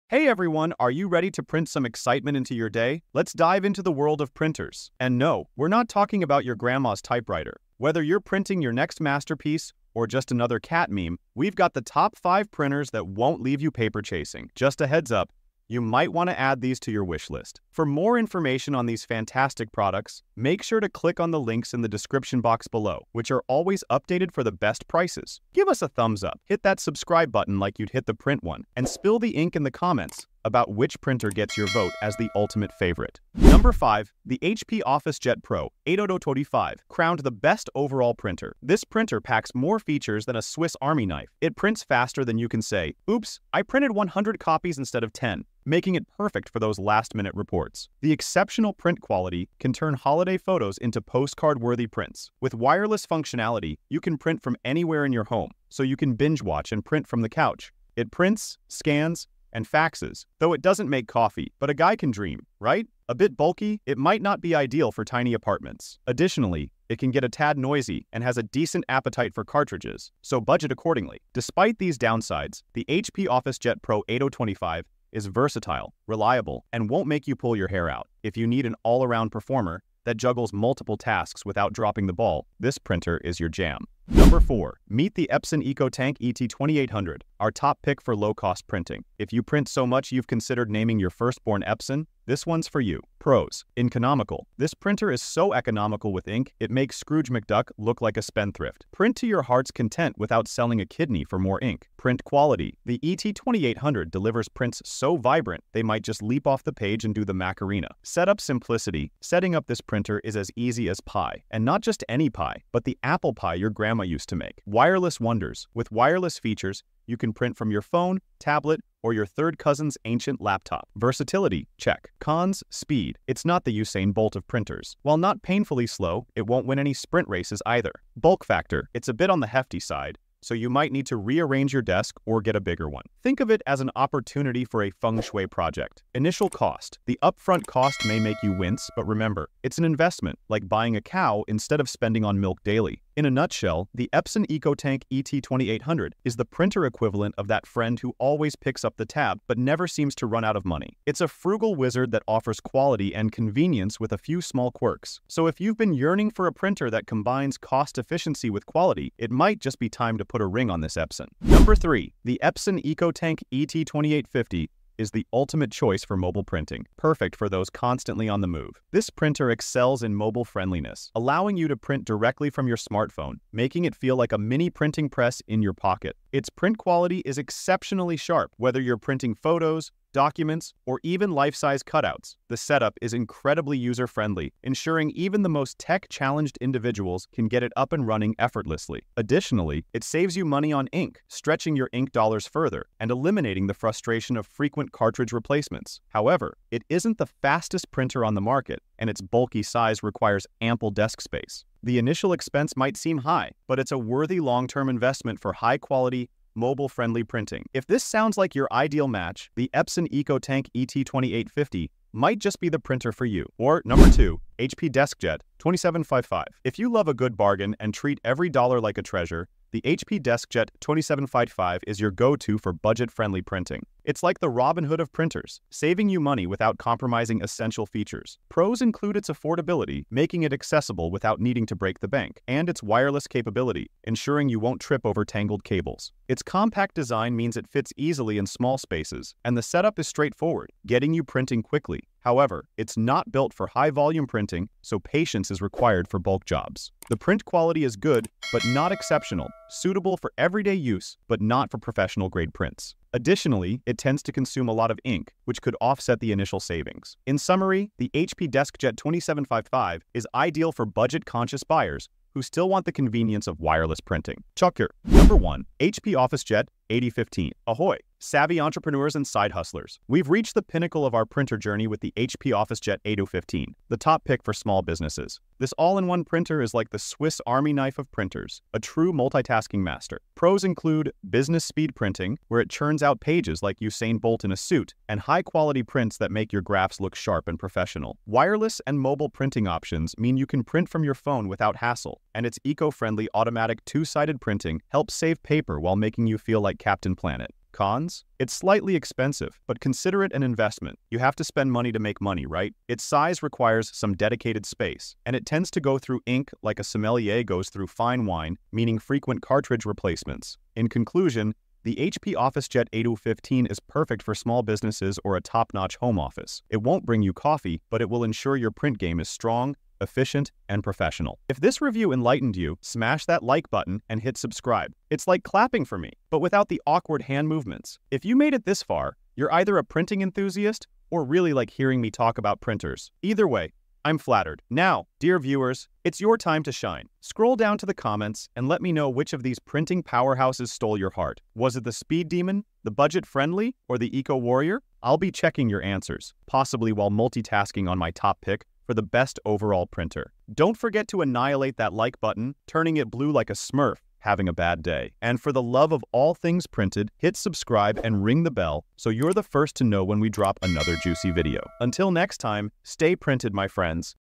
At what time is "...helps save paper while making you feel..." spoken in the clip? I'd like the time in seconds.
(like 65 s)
294 s.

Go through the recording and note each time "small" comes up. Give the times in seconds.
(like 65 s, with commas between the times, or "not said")
154 s, 238 s, 274 s, 314 s.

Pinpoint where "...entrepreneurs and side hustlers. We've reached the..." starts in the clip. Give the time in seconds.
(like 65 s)
268 s.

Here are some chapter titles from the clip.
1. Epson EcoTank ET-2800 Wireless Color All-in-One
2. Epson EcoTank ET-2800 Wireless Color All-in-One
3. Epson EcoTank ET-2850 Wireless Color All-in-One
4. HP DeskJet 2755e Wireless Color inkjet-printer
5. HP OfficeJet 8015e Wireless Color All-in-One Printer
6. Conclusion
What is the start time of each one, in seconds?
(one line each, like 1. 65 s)
1. 33 s
2. 84 s
3. 162 s
4. 213 s
5. 264 s
6. 339 s.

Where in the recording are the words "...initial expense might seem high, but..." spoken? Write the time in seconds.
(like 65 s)
201 s.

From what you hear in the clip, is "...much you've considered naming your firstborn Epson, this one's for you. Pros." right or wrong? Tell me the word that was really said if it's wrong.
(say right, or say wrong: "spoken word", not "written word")
right.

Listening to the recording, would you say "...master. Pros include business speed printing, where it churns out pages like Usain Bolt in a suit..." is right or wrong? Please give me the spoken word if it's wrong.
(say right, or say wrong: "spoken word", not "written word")
right.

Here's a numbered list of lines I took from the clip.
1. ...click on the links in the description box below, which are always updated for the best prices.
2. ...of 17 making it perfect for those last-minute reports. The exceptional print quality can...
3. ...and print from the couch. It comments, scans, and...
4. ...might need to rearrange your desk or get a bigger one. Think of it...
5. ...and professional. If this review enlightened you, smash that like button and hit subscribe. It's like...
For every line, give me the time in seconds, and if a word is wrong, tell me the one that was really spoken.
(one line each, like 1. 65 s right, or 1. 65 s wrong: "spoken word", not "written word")
1. 20 s right
2. 45 s wrong: "10", not "17"
3. 56 s wrong: "prints", not "comments"
4. 130 s right
5. 320 s right.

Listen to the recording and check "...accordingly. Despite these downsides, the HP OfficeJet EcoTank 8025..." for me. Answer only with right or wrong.
wrong.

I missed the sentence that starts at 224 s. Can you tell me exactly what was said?
It's like the Robin Hood of printers, saving you money without compromising essential features.